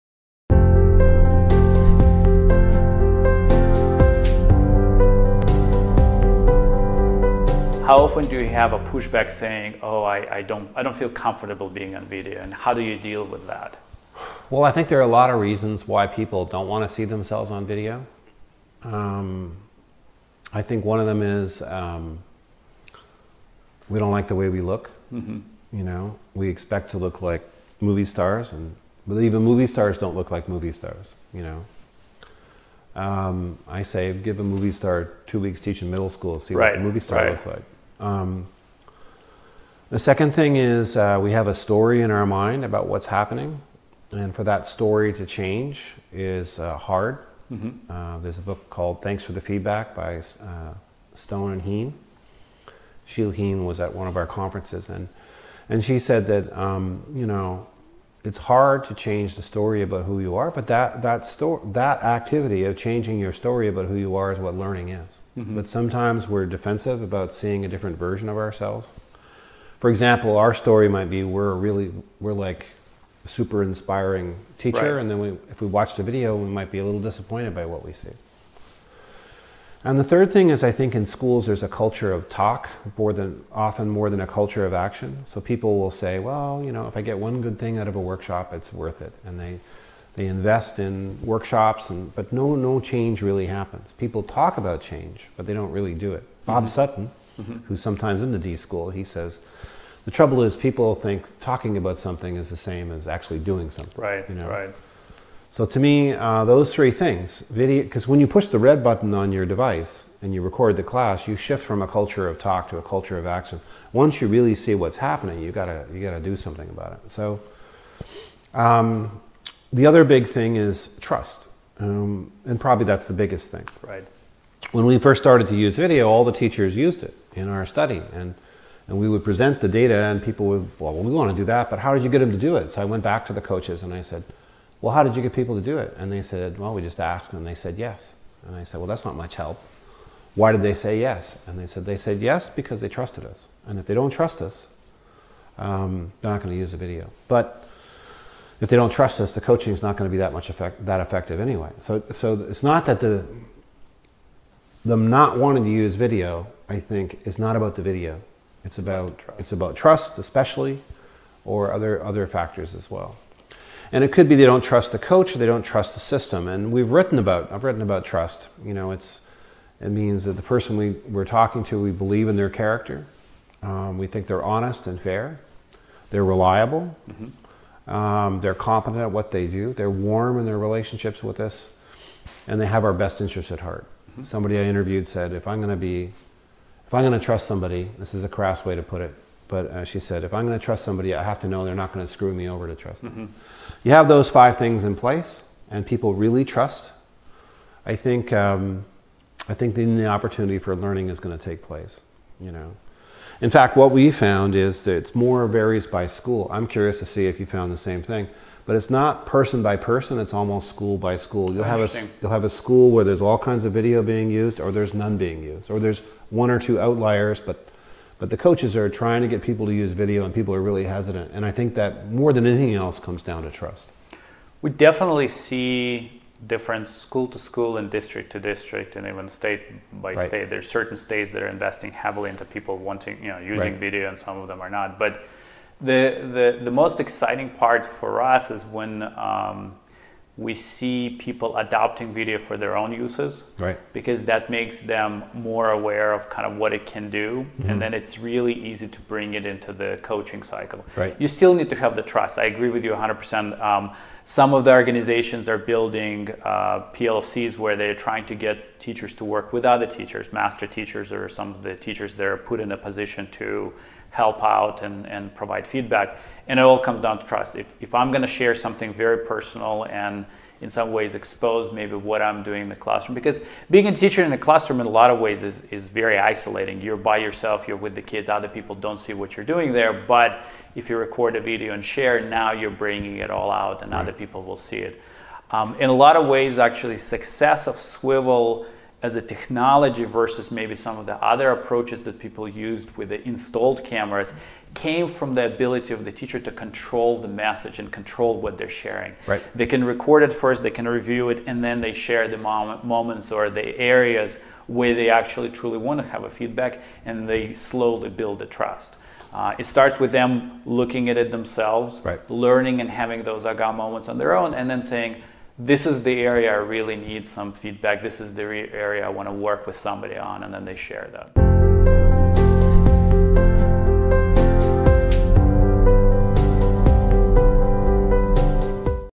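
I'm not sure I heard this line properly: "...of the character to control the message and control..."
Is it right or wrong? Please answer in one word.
wrong.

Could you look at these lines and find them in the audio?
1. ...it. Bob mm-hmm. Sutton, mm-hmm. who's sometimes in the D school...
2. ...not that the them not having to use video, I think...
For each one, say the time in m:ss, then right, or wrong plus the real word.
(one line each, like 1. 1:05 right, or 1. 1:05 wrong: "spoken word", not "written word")
1. 1:36 right
2. 2:32 wrong: "wanting", not "having".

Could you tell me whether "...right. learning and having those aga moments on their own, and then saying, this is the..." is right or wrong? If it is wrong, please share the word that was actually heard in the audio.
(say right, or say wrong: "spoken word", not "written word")
right.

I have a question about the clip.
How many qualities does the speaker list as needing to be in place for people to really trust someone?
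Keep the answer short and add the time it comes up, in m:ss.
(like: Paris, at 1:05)
5, at 3:14.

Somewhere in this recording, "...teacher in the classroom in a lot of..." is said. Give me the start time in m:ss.
4:33.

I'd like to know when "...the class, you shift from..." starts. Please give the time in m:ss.
1:50.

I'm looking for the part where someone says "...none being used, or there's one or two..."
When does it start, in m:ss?
3:34.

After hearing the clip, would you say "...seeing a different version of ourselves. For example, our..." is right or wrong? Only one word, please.
right.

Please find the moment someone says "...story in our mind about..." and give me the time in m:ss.
0:41.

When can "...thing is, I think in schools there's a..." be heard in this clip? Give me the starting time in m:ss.
1:20.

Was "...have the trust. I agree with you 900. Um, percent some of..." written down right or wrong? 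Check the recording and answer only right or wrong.
wrong.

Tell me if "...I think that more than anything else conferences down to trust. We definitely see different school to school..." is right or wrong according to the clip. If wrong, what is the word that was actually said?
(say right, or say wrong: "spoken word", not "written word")
wrong: "comes", not "conferences".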